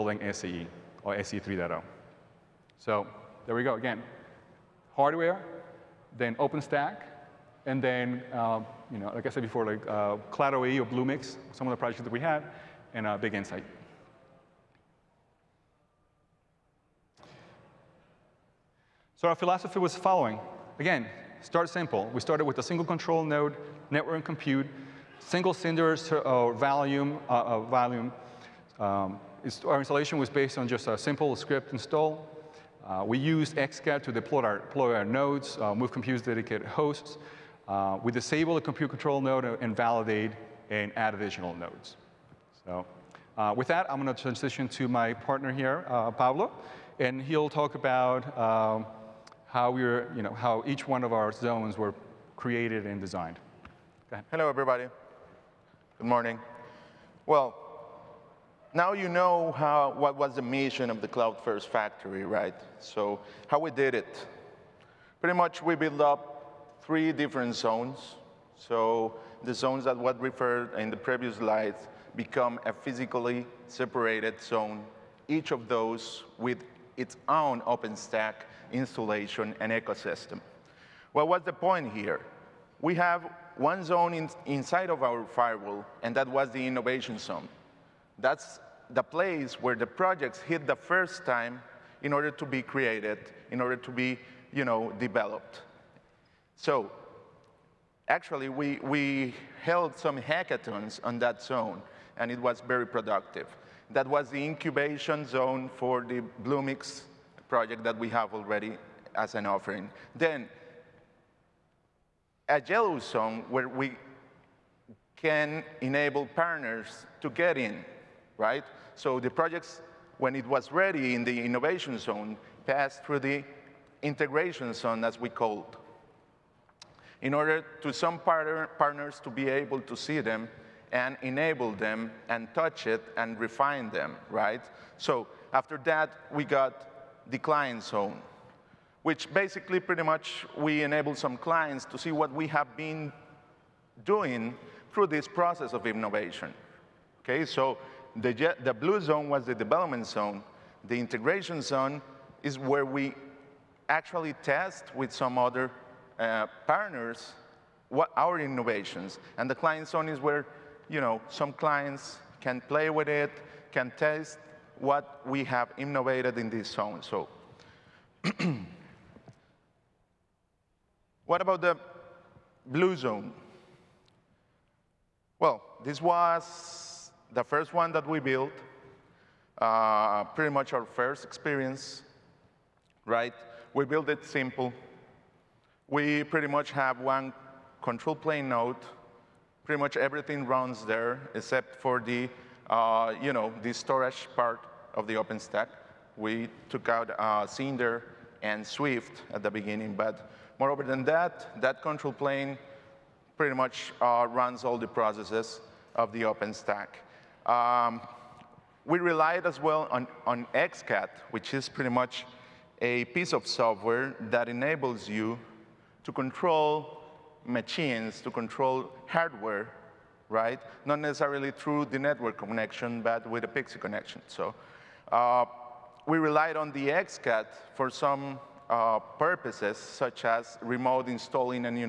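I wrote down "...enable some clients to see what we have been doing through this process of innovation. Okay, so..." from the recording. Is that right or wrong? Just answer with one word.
right.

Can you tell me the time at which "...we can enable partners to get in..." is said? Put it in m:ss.
1:53.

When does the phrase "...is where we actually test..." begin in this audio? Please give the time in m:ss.
2:32.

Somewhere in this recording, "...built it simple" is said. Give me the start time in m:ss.
3:03.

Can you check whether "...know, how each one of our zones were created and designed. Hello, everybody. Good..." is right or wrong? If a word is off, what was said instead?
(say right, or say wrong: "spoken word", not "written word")
right.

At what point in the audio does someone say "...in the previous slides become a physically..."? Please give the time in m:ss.
1:10.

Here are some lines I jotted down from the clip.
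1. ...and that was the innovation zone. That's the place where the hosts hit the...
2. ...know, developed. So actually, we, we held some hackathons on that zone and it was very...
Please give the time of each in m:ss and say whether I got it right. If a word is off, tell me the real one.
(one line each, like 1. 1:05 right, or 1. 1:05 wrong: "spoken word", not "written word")
1. 1:26 wrong: "projects", not "hosts"
2. 1:34 right.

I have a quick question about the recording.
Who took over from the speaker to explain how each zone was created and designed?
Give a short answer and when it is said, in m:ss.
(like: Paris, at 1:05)
Pablo, at 0:46.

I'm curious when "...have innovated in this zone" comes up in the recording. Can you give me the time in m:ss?
2:45.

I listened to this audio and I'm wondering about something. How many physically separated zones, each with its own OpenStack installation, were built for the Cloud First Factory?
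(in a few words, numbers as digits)
3.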